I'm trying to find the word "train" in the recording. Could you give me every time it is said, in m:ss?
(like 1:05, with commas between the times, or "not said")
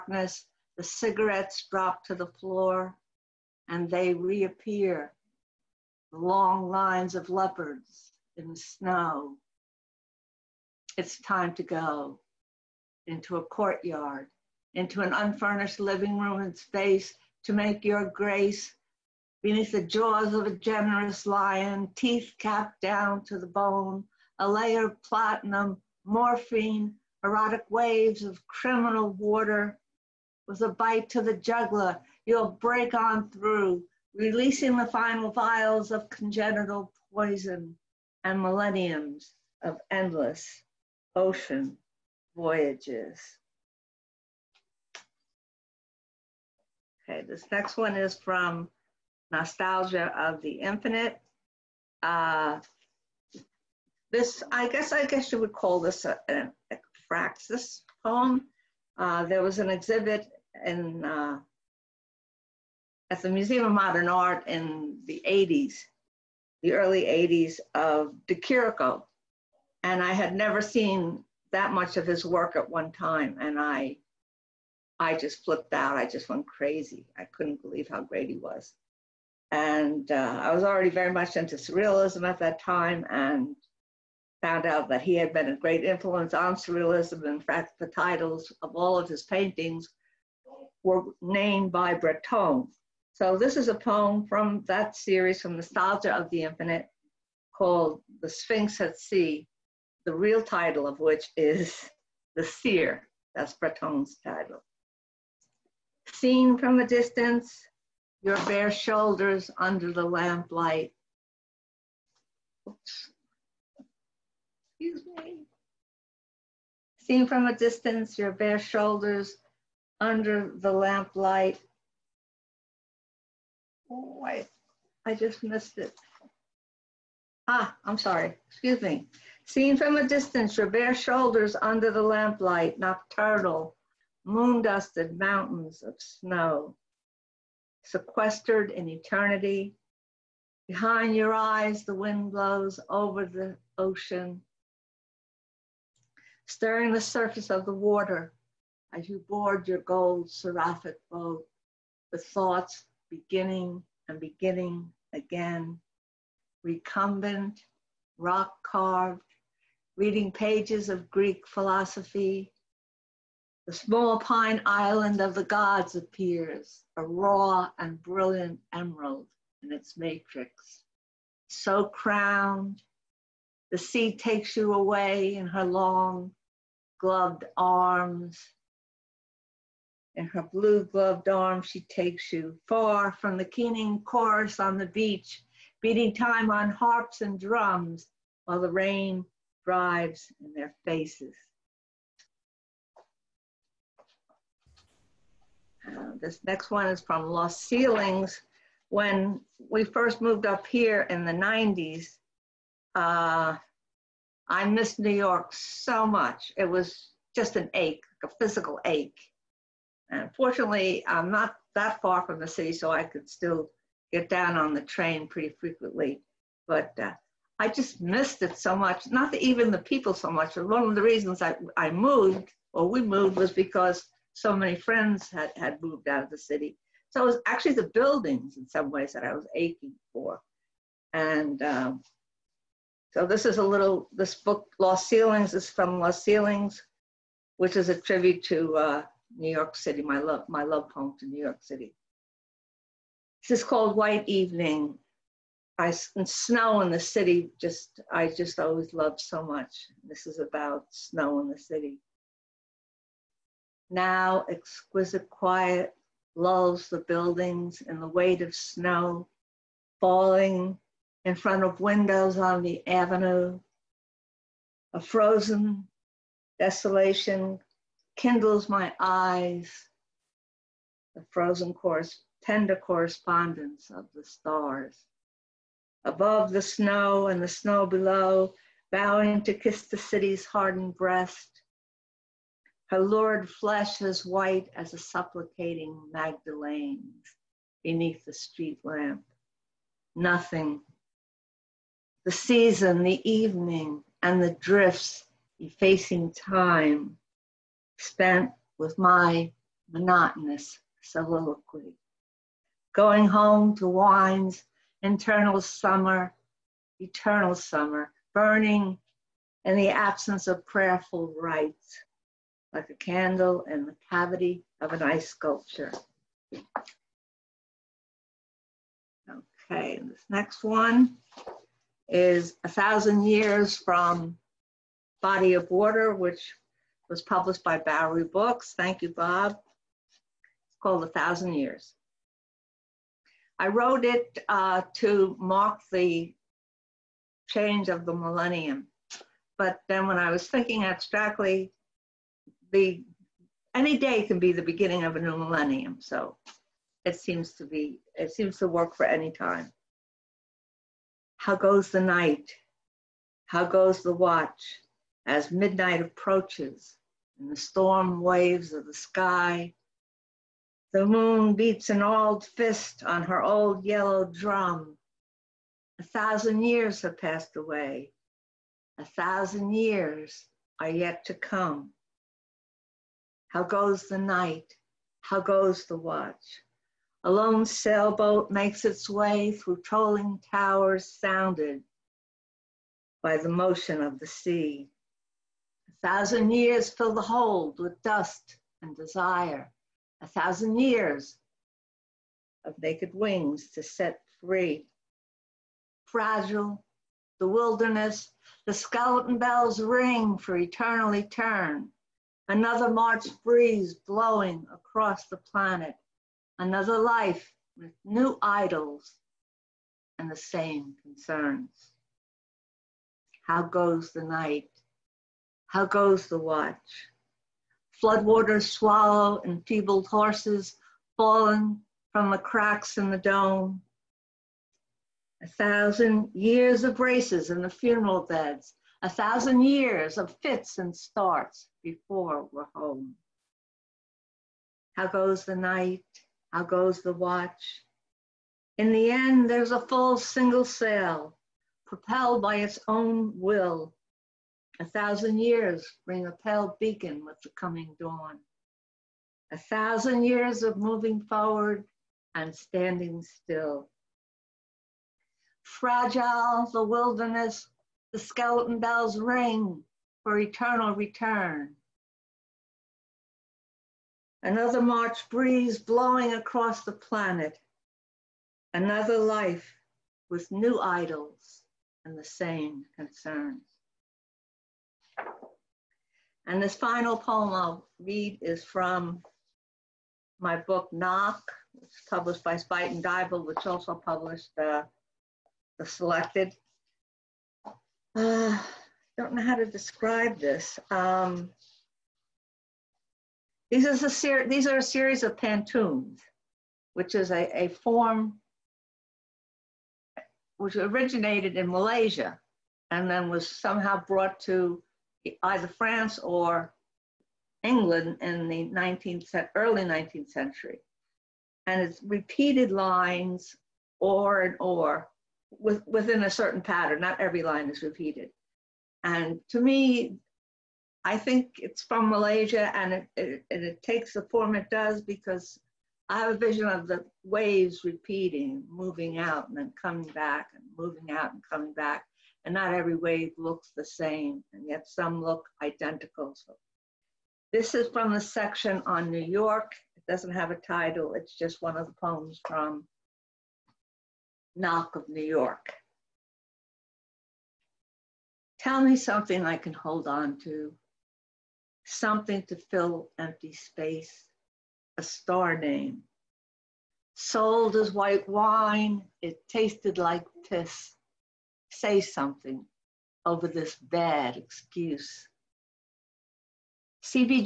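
3:34.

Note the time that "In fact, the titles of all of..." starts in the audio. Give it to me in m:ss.
1:27.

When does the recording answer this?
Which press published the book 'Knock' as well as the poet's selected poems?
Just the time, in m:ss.
8:02.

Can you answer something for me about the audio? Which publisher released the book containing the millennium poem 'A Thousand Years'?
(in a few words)
Bowery Books.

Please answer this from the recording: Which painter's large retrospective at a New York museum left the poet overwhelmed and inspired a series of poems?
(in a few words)
De Chirico.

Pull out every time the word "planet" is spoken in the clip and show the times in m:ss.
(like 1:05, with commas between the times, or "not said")
6:45, 7:46.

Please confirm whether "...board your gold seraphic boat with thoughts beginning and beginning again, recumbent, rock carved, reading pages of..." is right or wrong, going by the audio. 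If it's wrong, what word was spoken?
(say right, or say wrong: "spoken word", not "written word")
right.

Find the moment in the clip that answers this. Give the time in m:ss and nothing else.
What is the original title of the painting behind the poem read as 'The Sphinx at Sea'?
1:42.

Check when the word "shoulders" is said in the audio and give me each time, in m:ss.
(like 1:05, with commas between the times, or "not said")
1:48, 1:58, 2:10.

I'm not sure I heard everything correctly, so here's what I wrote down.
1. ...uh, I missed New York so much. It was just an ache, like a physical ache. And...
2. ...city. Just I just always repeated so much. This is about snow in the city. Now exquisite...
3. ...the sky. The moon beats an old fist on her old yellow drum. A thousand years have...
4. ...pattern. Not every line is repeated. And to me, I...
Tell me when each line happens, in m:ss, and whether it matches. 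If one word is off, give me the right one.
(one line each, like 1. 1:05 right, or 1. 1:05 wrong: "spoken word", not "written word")
1. 3:22 right
2. 4:06 wrong: "loved", not "repeated"
3. 5:58 right
4. 8:36 right.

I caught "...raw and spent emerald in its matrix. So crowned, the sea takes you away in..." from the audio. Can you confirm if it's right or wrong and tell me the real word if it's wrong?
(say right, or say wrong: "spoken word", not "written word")
wrong: "brilliant", not "spent".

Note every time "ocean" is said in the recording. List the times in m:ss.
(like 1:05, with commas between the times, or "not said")
0:41, 2:23.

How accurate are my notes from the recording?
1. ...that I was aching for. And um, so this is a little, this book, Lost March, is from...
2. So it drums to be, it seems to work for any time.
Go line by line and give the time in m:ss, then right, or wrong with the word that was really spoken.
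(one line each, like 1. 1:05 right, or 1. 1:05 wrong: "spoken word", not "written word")
1. 3:49 wrong: "Ceilings", not "March"
2. 5:45 wrong: "seems", not "drums".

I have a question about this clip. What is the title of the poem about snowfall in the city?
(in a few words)
White Evening.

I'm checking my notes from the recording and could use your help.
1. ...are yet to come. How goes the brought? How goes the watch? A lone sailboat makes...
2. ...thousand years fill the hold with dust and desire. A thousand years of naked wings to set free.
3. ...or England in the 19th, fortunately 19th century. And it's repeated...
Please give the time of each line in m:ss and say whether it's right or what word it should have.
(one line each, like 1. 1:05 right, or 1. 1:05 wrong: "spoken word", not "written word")
1. 6:10 wrong: "night", not "brought"
2. 6:26 right
3. 8:26 wrong: "early", not "fortunately".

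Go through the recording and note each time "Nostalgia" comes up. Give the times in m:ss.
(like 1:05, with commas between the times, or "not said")
0:49, 1:35.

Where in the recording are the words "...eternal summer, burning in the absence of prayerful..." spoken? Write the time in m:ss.
5:06.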